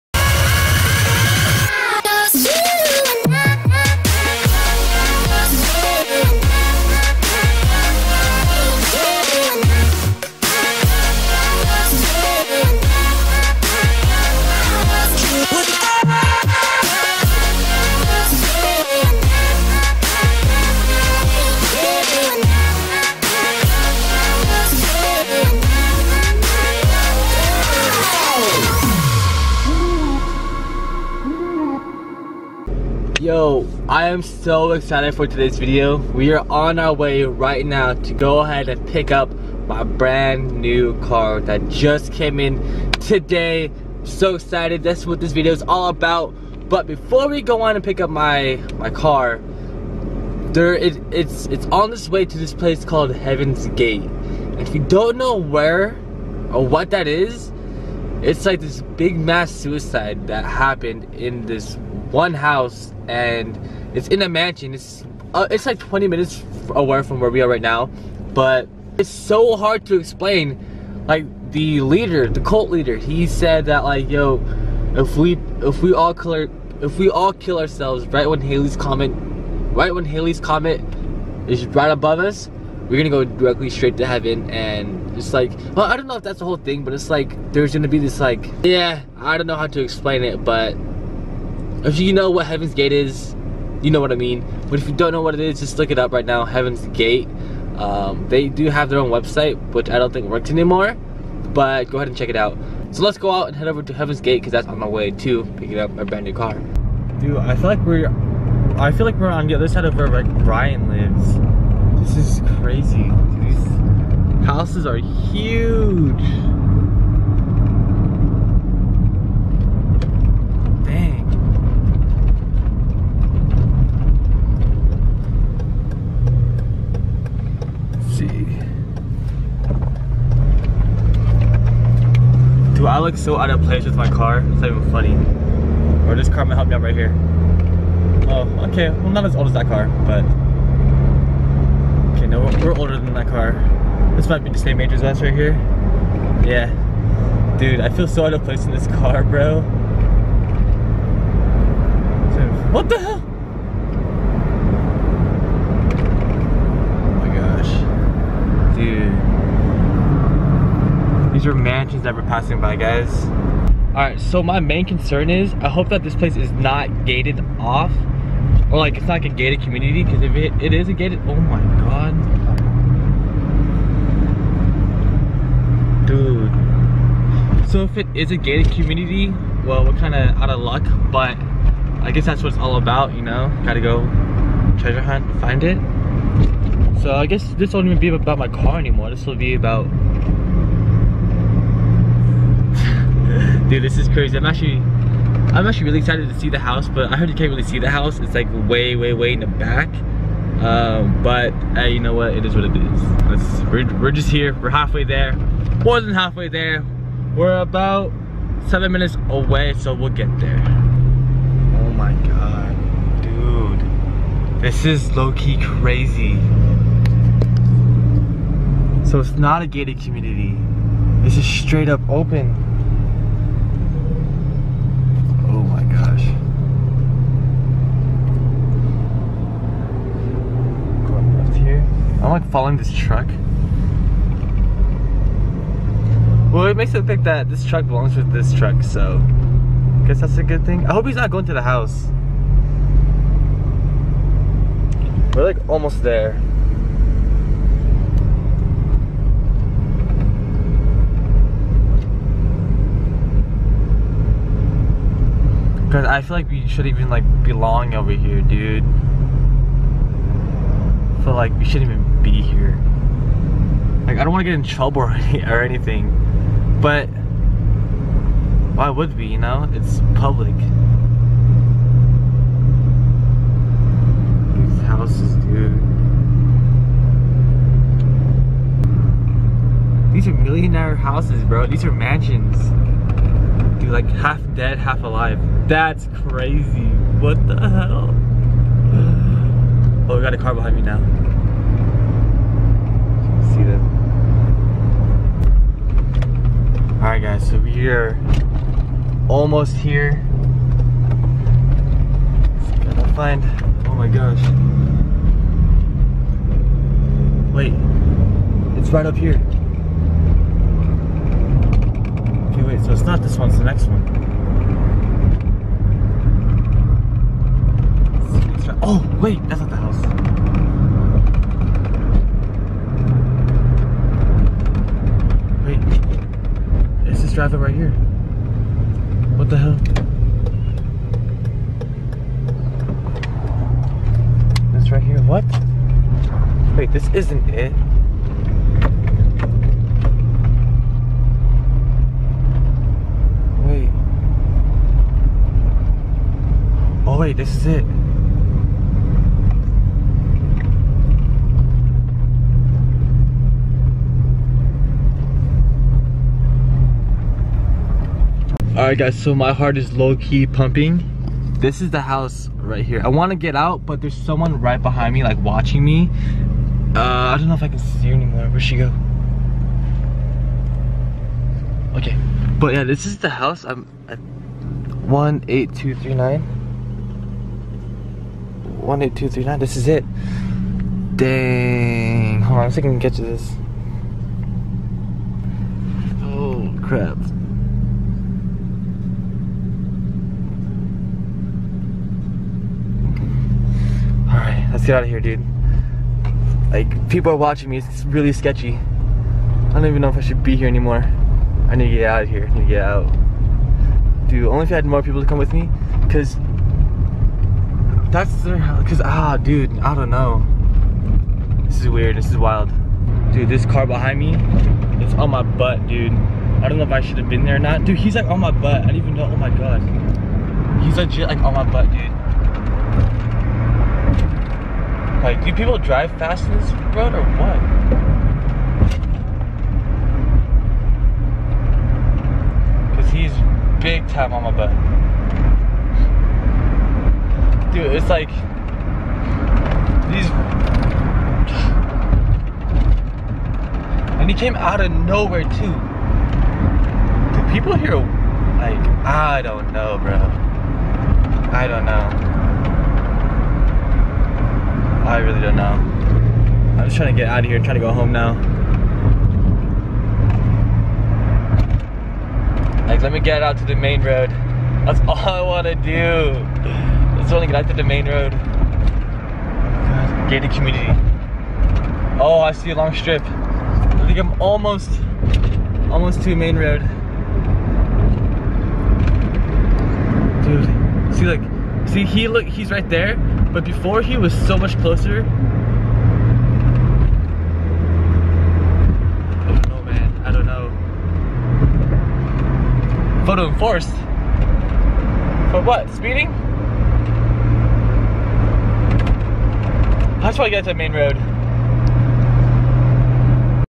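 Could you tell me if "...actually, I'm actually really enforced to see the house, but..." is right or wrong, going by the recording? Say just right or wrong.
wrong.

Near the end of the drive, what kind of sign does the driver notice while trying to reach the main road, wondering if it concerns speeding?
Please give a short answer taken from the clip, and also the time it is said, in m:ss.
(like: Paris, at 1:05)
Photo enforced, at 8:13.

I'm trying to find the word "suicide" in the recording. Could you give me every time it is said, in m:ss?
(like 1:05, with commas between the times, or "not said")
0:59.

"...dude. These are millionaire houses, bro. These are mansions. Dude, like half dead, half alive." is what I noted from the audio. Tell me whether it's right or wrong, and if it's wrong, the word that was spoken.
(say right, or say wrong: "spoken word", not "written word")
right.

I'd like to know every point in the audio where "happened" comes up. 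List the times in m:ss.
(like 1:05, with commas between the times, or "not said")
1:00.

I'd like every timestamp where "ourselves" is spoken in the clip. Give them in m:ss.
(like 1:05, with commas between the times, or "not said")
1:17.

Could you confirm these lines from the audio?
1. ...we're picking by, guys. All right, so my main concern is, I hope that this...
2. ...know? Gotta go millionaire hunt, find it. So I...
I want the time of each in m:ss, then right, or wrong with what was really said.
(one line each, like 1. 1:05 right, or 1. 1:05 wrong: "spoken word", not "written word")
1. 2:42 wrong: "passing", not "picking"
2. 3:03 wrong: "treasure", not "millionaire".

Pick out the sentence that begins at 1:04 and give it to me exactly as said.
It's uh, it's like 20 minutes away from where we are right now, but it's so hard to explain.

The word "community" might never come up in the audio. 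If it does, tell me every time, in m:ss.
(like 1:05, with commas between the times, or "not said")
2:49, 2:58, 3:40, 7:50.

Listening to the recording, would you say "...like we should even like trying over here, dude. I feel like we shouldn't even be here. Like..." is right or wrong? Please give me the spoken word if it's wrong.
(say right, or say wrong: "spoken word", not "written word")
wrong: "belong", not "trying".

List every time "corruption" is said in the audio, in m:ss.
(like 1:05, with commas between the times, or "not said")
not said.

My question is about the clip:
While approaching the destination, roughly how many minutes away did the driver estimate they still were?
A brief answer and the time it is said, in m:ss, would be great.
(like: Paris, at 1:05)
7 minutes, at 3:28.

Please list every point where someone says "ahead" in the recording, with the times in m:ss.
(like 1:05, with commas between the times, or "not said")
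0:38, 1:41.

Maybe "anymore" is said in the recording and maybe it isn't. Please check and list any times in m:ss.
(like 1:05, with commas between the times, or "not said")
1:40, 3:08, 6:08, 6:40.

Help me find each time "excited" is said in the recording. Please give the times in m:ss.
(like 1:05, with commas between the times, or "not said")
0:34, 0:44, 3:15.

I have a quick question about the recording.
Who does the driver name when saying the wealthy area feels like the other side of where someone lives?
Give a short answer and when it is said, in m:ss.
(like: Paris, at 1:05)
Brian, at 1:50.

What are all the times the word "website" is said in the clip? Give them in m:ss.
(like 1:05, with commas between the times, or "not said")
1:39.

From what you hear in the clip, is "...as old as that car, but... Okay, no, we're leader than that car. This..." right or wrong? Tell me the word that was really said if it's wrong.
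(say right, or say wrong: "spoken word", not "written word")
wrong: "older", not "leader".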